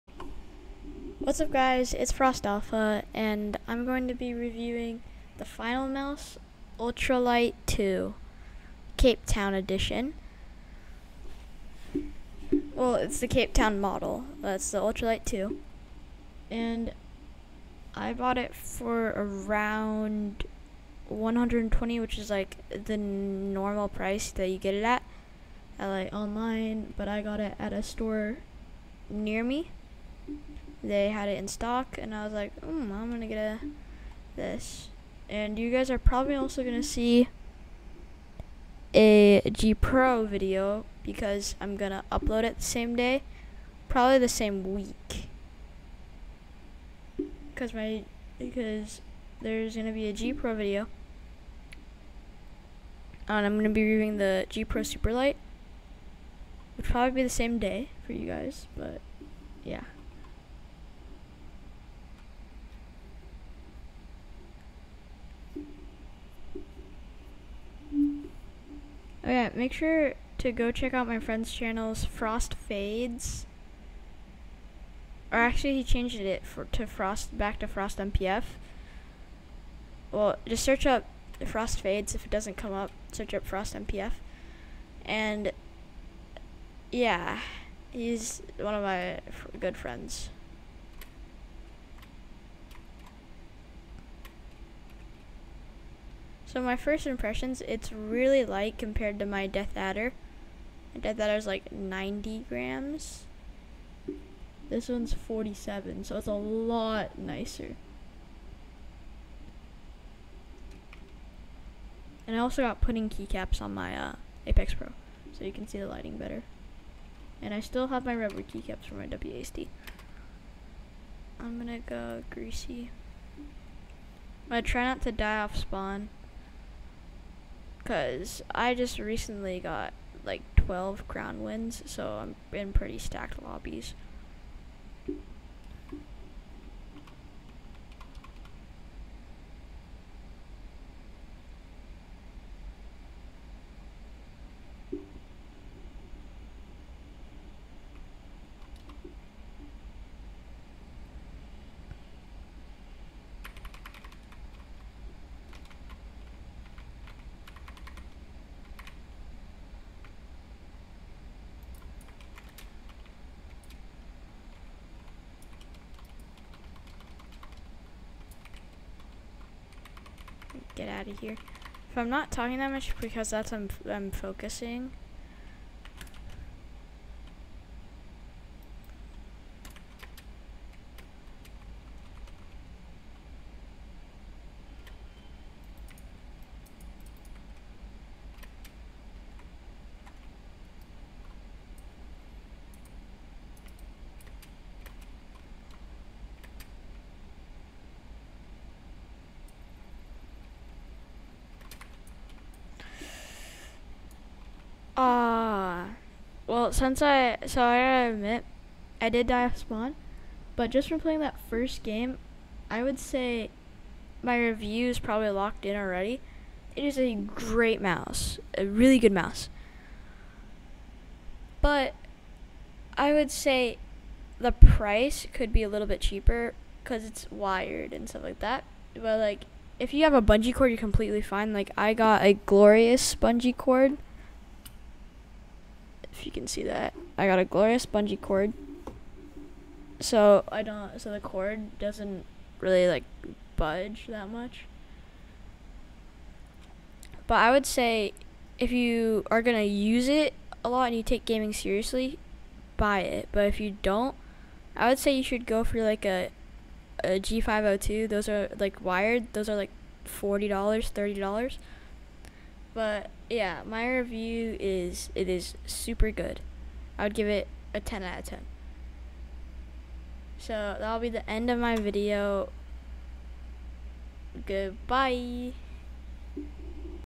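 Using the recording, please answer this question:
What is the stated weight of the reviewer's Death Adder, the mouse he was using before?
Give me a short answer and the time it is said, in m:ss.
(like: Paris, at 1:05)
90 grams, at 1:41.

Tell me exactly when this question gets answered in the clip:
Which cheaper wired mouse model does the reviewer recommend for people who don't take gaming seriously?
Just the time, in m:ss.
4:17.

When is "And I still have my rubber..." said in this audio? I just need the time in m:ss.
1:57.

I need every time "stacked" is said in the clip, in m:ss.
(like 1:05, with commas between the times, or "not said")
2:12.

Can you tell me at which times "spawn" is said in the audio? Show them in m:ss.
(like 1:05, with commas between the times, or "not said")
2:05, 3:29.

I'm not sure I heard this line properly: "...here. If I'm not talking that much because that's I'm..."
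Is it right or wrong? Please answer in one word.
right.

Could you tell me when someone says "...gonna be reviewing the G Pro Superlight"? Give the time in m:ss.
0:53.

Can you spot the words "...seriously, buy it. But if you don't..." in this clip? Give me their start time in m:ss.
4:11.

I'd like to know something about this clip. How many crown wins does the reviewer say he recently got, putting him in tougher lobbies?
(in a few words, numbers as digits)
12.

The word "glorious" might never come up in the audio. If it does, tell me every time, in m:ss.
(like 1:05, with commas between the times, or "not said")
3:52, 3:57.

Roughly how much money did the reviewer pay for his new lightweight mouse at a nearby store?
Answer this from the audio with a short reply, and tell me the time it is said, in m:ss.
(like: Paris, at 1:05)
120, at 0:21.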